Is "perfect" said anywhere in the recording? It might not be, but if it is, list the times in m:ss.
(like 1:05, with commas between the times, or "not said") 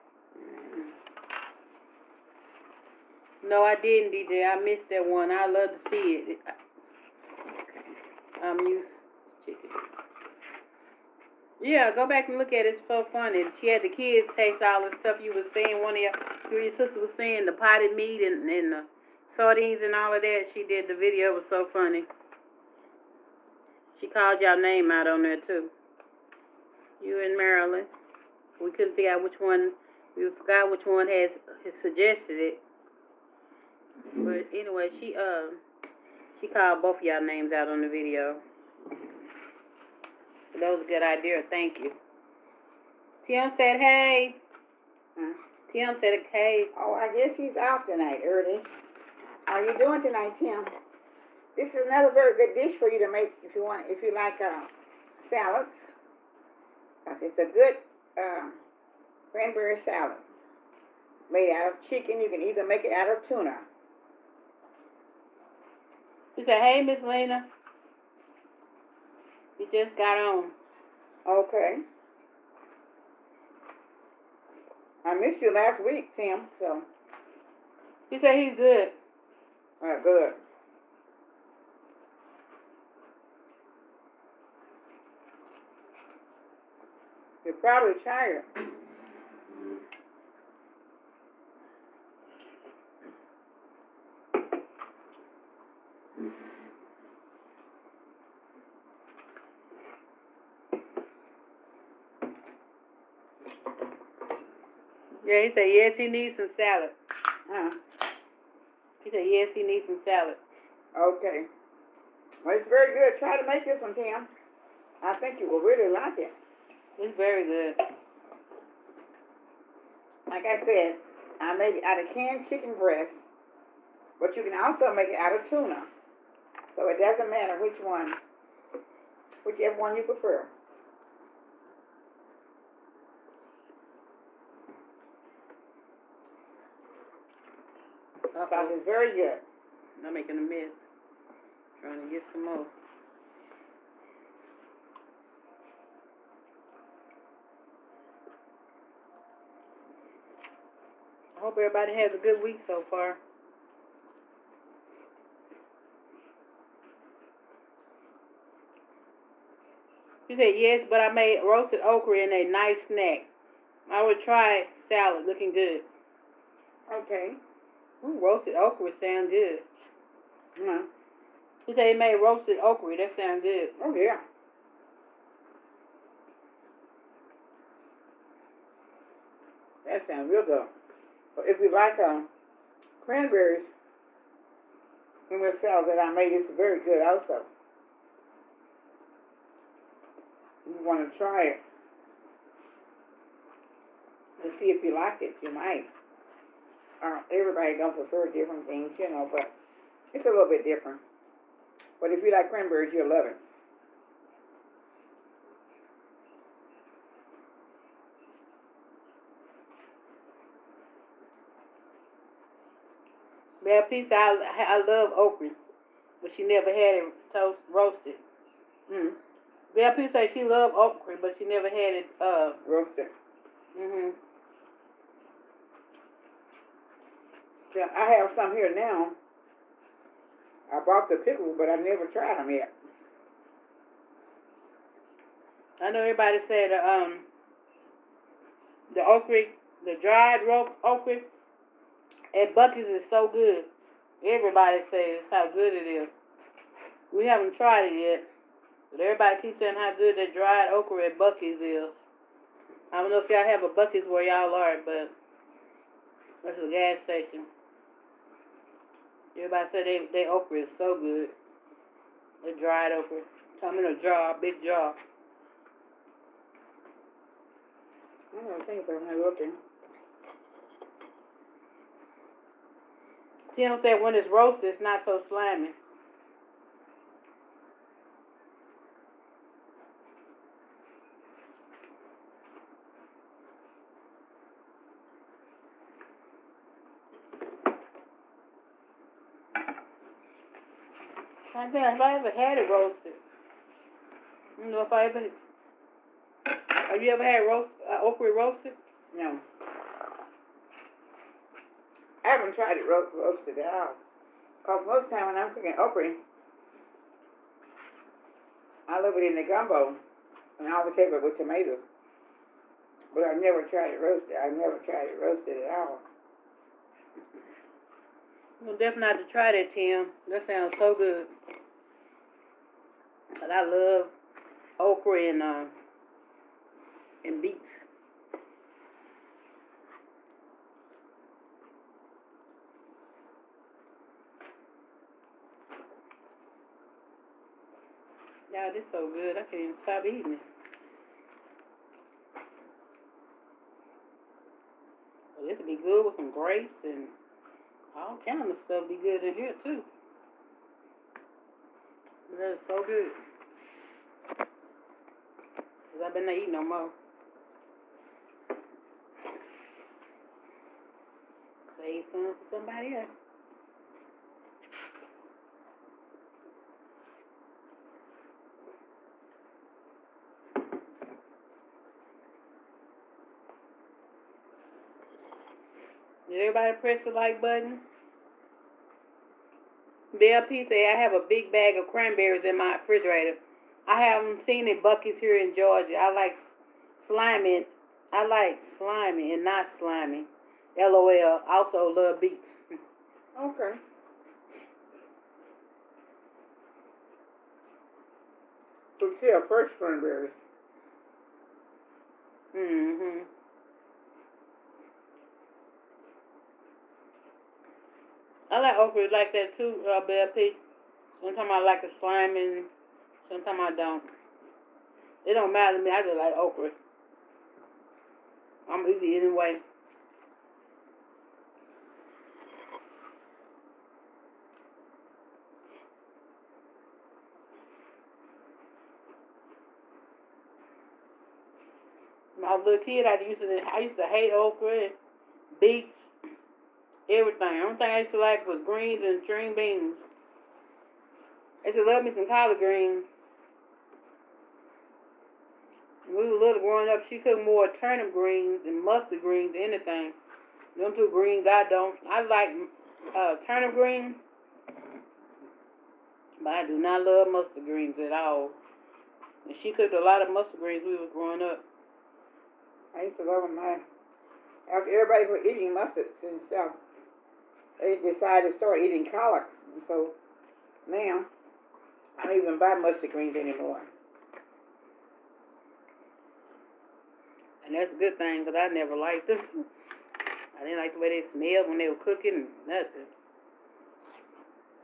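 not said.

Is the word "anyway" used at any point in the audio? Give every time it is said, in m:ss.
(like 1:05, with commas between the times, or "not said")
0:34, 6:59.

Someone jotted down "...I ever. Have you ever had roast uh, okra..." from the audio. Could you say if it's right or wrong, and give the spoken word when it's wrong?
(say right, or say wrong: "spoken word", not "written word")
right.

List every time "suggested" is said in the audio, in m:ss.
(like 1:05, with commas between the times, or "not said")
0:31.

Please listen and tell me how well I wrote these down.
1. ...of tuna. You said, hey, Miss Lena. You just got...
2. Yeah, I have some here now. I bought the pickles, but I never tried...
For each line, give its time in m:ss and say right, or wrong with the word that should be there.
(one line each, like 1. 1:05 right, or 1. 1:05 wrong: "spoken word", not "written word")
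1. 1:03 right
2. 3:47 right.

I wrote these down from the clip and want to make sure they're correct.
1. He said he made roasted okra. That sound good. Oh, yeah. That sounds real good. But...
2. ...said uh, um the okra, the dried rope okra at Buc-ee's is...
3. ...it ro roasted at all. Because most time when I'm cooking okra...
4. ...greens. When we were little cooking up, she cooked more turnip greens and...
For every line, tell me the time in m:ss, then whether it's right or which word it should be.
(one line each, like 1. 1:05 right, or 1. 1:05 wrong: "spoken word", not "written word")
1. 2:51 right
2. 3:56 right
3. 5:02 right
4. 7:22 wrong: "growing", not "cooking".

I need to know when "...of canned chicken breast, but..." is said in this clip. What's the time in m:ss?
2:01.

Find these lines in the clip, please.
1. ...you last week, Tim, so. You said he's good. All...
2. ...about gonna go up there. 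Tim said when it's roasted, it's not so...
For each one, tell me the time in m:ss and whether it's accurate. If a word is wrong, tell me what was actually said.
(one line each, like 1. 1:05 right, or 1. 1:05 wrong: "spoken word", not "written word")
1. 1:15 right
2. 4:28 right.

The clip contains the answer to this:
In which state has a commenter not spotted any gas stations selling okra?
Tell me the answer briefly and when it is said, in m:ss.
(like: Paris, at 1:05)
Georgia, at 6:25.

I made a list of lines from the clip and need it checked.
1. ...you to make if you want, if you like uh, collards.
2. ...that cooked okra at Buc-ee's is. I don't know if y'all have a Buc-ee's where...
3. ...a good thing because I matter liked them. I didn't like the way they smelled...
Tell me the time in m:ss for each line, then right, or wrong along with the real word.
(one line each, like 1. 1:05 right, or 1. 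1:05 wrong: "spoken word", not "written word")
1. 0:52 wrong: "salads", not "collards"
2. 4:10 wrong: "dried", not "cooked"
3. 7:57 wrong: "never", not "matter".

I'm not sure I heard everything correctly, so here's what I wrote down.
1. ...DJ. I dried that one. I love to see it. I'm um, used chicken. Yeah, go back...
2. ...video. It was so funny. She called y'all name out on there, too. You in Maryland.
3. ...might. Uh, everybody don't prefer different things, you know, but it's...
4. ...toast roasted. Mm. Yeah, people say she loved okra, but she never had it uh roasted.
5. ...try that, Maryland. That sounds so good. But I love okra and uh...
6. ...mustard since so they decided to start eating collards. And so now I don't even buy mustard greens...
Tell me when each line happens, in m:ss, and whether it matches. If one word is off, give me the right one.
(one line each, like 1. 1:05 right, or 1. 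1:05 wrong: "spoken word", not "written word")
1. 0:04 wrong: "missed", not "dried"
2. 0:20 right
3. 3:15 right
4. 3:37 right
5. 5:19 wrong: "Tim", not "Maryland"
6. 7:45 right.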